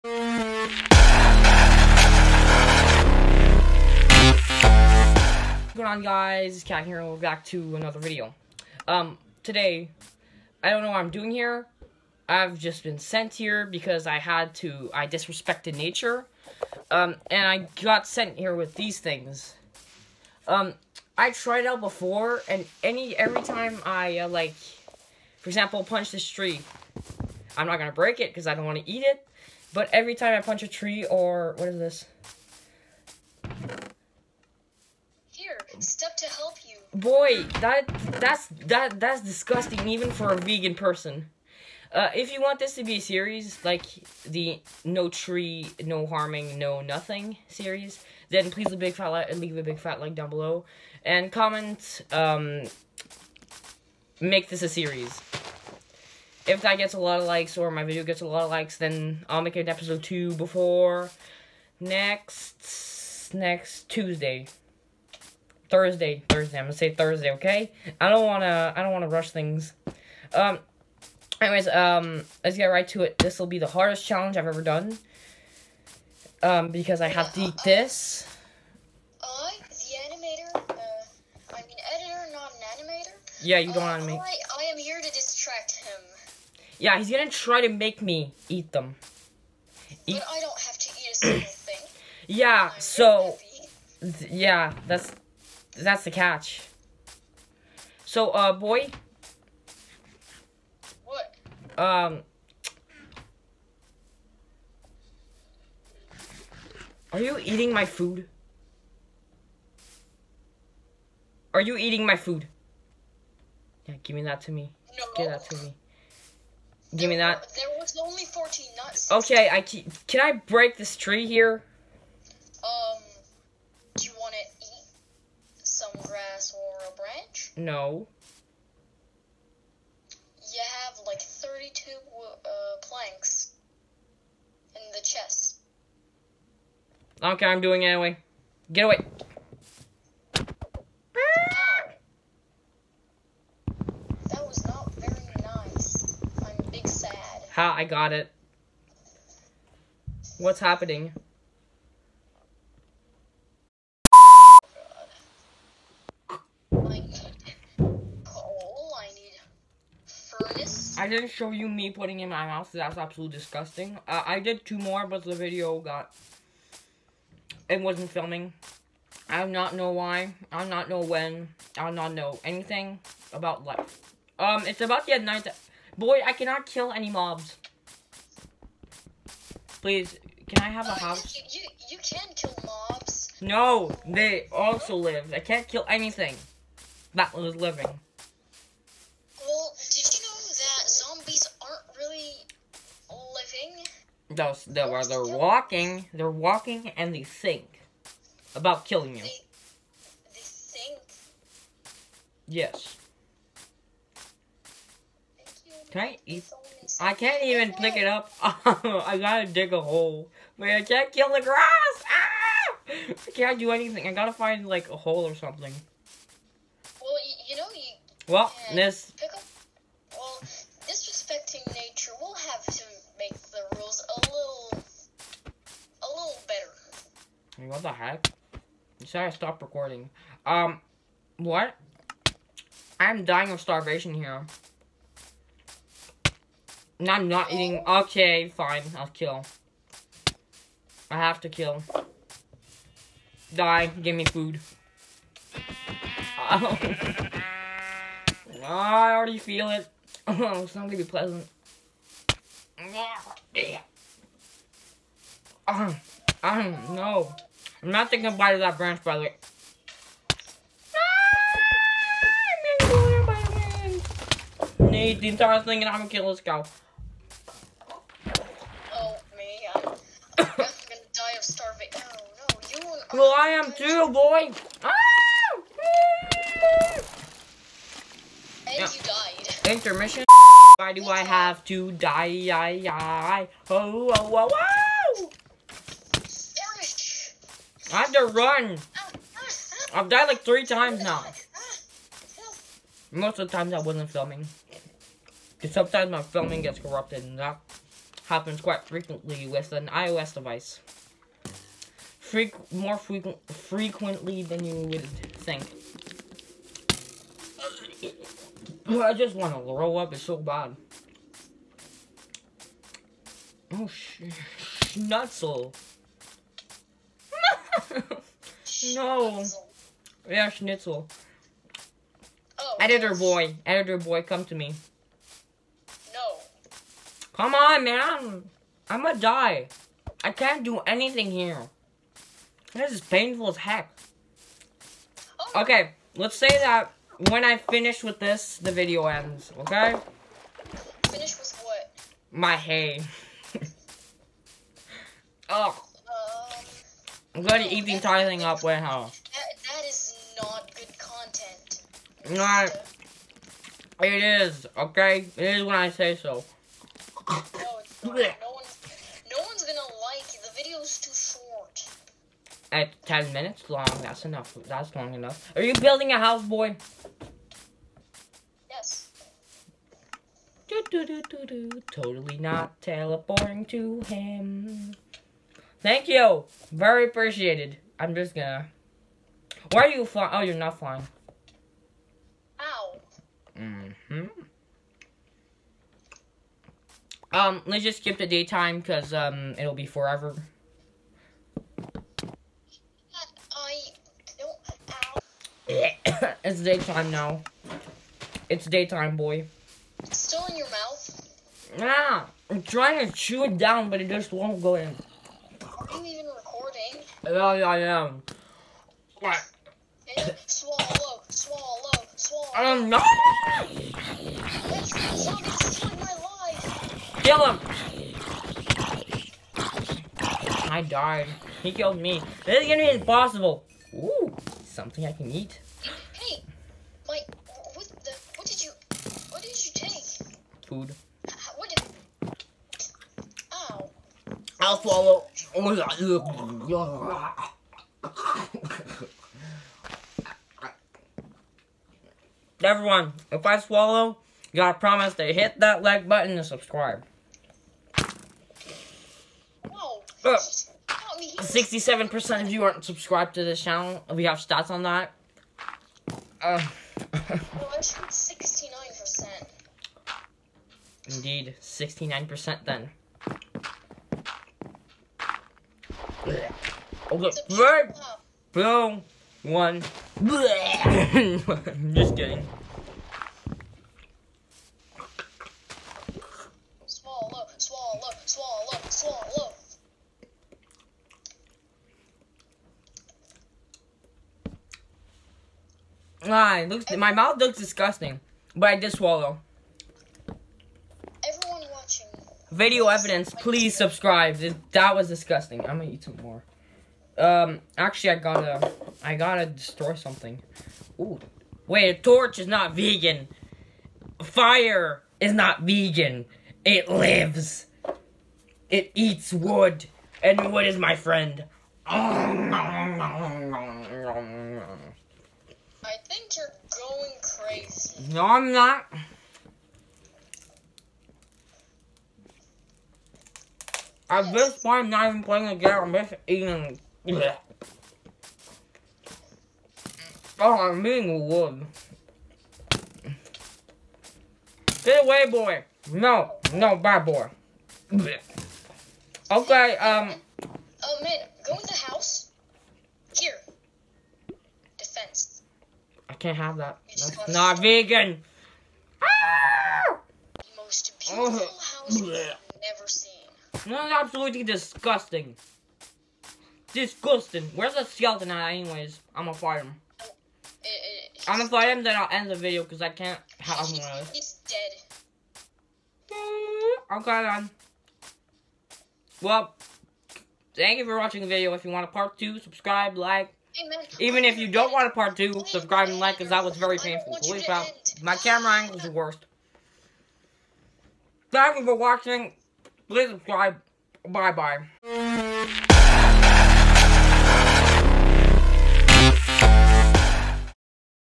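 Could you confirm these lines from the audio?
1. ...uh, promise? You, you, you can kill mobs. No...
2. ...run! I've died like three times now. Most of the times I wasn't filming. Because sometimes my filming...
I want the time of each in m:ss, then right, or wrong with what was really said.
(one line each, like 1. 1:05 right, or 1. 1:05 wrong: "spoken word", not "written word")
1. 3:00 wrong: "house", not "promise"
2. 4:48 right.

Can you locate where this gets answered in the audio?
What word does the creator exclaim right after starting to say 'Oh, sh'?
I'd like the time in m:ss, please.
5:20.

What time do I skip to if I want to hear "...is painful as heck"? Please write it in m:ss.
5:32.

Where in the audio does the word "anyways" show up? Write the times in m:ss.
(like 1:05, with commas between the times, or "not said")
1:11, 2:17, 9:18.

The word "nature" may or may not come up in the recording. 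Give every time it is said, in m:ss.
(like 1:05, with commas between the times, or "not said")
0:15, 3:41.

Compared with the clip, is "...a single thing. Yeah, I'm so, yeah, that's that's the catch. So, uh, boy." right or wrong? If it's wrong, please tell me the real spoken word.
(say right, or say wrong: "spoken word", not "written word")
right.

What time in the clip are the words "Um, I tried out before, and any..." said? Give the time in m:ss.
0:20.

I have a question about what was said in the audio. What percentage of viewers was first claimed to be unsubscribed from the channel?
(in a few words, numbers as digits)
67%.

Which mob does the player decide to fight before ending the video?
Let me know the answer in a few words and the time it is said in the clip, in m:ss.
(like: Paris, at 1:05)
skeleton, at 9:17.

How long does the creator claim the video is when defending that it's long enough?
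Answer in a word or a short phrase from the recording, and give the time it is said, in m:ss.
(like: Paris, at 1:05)
10 minutes, at 6:03.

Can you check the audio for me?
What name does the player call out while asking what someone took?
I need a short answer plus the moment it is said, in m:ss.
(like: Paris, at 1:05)
Mike, at 7:07.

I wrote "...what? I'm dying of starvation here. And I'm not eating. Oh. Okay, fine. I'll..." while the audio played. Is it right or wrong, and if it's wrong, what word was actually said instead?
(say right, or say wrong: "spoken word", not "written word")
right.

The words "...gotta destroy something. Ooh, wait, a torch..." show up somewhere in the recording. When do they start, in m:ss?
8:19.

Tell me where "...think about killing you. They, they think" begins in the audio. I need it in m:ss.
3:17.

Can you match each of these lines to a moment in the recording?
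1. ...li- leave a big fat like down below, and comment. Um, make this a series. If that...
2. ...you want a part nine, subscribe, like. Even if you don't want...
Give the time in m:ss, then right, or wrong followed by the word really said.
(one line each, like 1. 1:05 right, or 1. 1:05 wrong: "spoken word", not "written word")
1. 0:49 right
2. 9:31 wrong: "two", not "nine".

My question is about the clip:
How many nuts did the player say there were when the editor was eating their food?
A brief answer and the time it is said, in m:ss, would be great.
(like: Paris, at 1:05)
14, at 1:58.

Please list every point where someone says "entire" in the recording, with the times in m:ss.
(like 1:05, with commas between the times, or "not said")
4:25, 5:47.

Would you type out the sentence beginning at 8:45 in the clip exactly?
I'm just eating Oh, I'm being wood.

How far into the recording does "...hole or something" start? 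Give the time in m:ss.
3:34.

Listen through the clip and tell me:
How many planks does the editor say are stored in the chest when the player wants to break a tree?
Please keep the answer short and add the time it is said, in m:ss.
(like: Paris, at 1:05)
32, at 2:11.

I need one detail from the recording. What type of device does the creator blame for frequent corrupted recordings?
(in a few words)
iOS device.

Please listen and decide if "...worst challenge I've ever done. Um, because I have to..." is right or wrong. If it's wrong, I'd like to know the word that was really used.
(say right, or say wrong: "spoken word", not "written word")
wrong: "hardest", not "worst".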